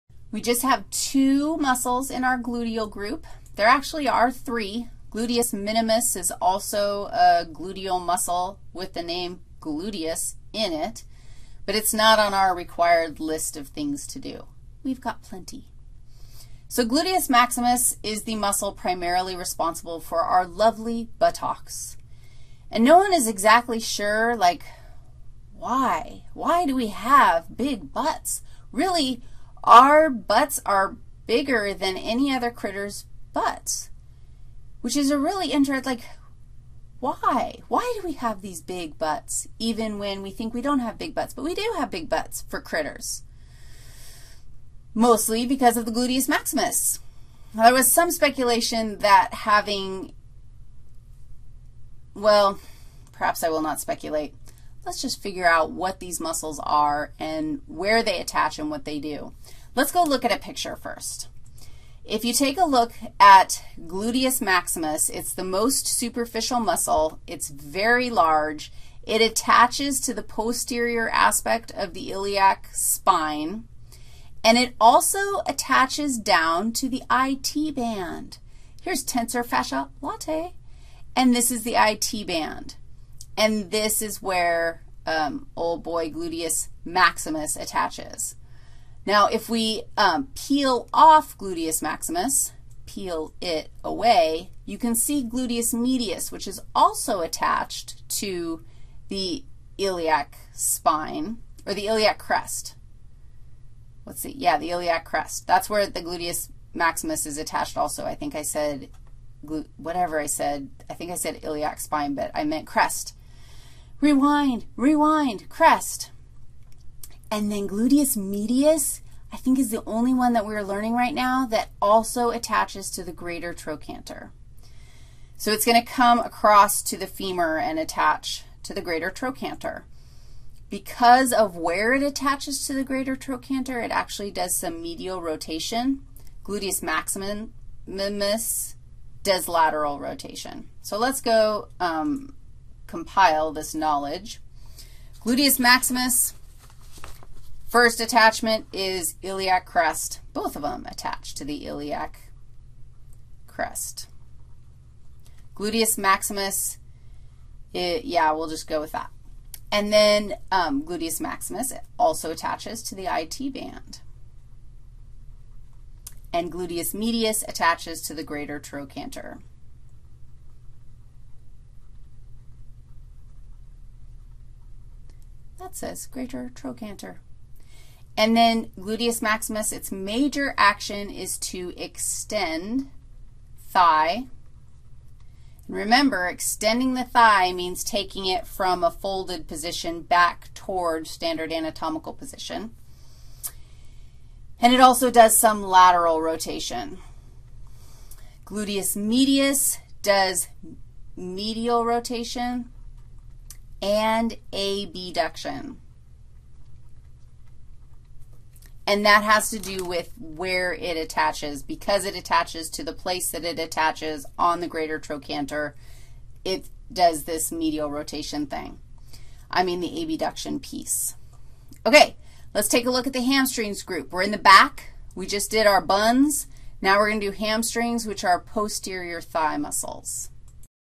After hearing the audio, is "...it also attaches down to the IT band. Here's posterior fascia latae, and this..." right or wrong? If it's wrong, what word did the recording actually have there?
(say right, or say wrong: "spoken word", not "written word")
wrong: "tensor", not "posterior".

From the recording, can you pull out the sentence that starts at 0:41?
But we do have big butts for critters, mostly because of the gluteus maximus.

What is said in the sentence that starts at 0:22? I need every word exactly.
And no one is exactly sure, like, why?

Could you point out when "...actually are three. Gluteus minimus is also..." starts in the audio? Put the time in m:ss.
0:03.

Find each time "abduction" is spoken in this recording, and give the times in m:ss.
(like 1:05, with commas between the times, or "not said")
3:24, 3:40.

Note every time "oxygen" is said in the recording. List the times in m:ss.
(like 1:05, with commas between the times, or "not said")
not said.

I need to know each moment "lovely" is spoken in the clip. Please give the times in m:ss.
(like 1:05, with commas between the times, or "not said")
0:20.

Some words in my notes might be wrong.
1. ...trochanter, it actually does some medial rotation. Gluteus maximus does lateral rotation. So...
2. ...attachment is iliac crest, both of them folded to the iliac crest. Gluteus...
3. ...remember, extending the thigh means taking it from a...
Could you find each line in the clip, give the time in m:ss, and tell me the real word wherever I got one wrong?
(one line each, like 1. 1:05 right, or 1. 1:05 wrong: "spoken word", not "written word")
1. 2:13 right
2. 2:28 wrong: "attached", not "folded"
3. 3:05 right.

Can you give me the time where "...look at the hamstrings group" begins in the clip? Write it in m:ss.
3:42.